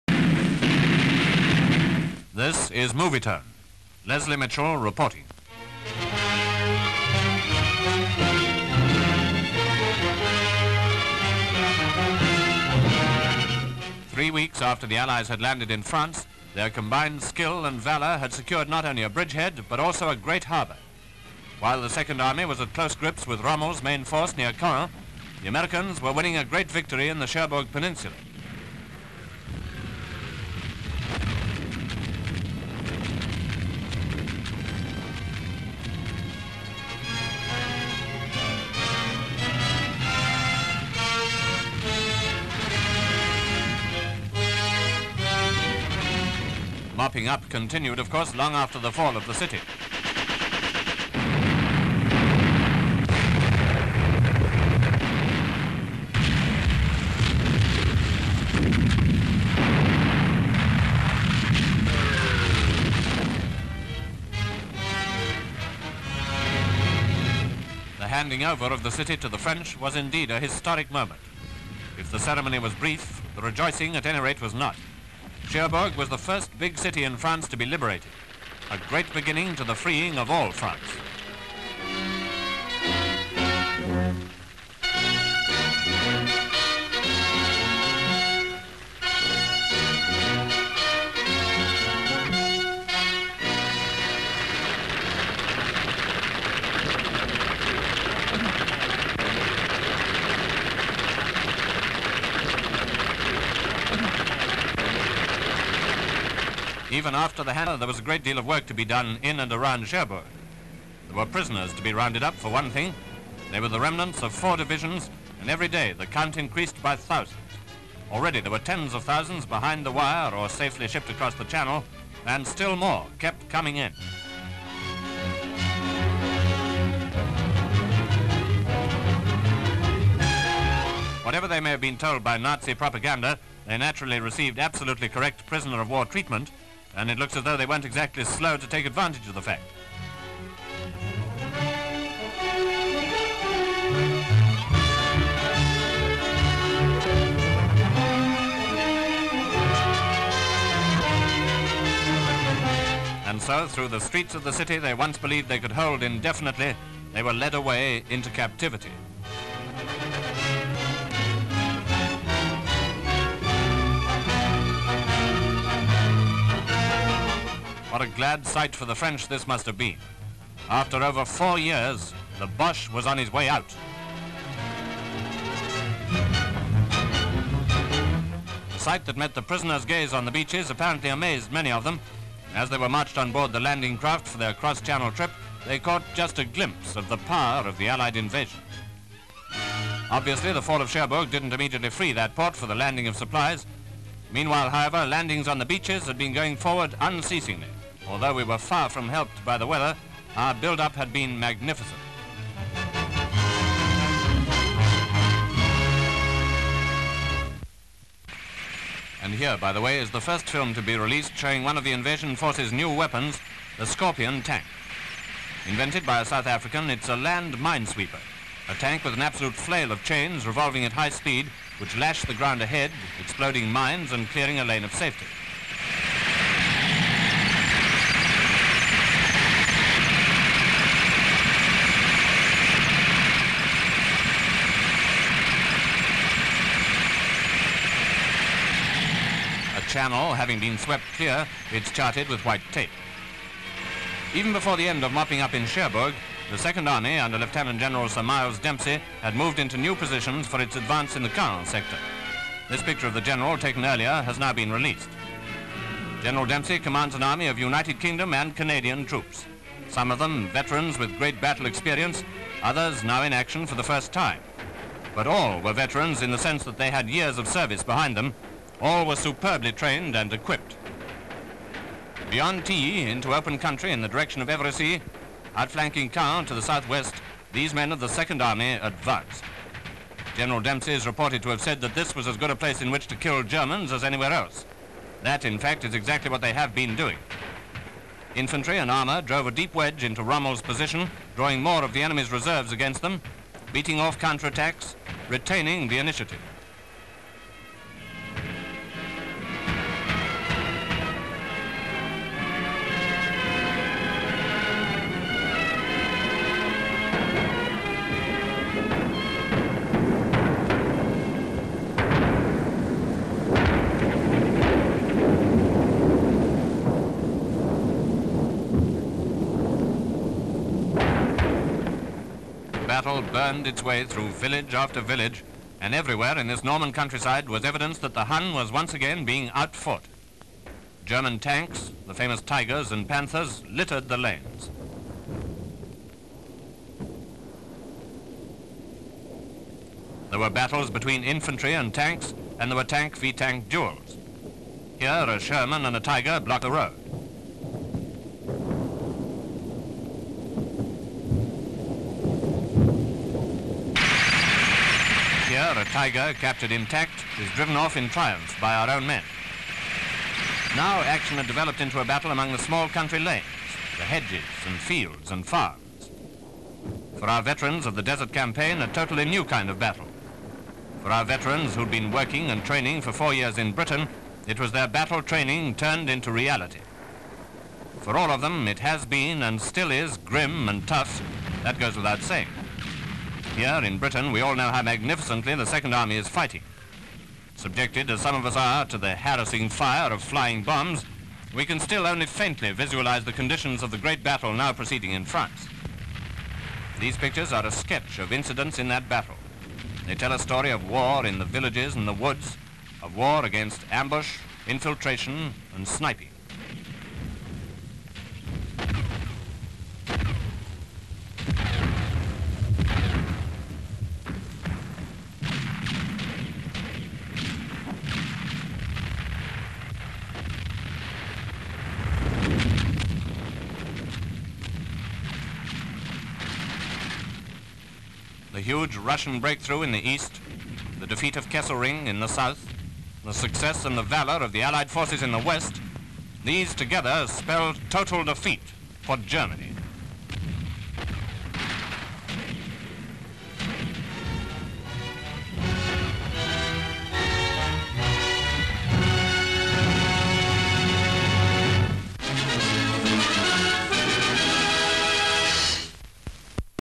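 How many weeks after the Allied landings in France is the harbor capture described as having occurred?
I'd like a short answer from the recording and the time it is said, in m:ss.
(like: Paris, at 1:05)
3, at 0:14.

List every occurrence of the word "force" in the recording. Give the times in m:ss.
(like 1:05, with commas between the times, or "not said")
0:24, 3:32, 7:14.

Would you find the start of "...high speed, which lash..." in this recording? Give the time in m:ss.
3:40.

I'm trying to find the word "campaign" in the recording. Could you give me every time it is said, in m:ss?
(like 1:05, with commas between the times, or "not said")
6:08.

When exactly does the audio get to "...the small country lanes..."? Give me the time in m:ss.
6:02.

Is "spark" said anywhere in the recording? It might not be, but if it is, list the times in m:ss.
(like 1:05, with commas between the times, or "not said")
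not said.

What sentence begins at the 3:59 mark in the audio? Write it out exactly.
channel having been swept clear, it's charted with white tape.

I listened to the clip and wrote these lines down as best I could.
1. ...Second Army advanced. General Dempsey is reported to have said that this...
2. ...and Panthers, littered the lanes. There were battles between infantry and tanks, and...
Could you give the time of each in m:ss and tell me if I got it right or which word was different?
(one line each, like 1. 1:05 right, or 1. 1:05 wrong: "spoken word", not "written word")
1. 4:38 right
2. 5:32 right.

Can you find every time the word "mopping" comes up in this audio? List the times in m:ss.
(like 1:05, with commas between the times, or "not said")
0:47, 4:05.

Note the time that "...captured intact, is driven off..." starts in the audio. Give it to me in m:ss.
5:56.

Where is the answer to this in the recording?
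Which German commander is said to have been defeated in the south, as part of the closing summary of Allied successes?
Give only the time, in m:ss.
7:11.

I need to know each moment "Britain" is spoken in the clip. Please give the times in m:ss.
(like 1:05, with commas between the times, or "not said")
6:13, 6:23.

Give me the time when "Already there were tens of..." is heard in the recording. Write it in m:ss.
1:58.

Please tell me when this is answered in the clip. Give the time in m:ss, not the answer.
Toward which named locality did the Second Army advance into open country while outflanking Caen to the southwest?
4:34.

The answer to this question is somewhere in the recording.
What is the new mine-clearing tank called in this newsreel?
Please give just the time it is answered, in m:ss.
3:33.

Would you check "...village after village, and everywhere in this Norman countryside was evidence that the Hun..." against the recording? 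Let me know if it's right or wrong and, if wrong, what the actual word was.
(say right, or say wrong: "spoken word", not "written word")
right.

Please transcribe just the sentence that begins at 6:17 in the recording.
For all of them, it has been and still is grim and tough.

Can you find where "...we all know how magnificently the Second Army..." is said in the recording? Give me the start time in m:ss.
6:24.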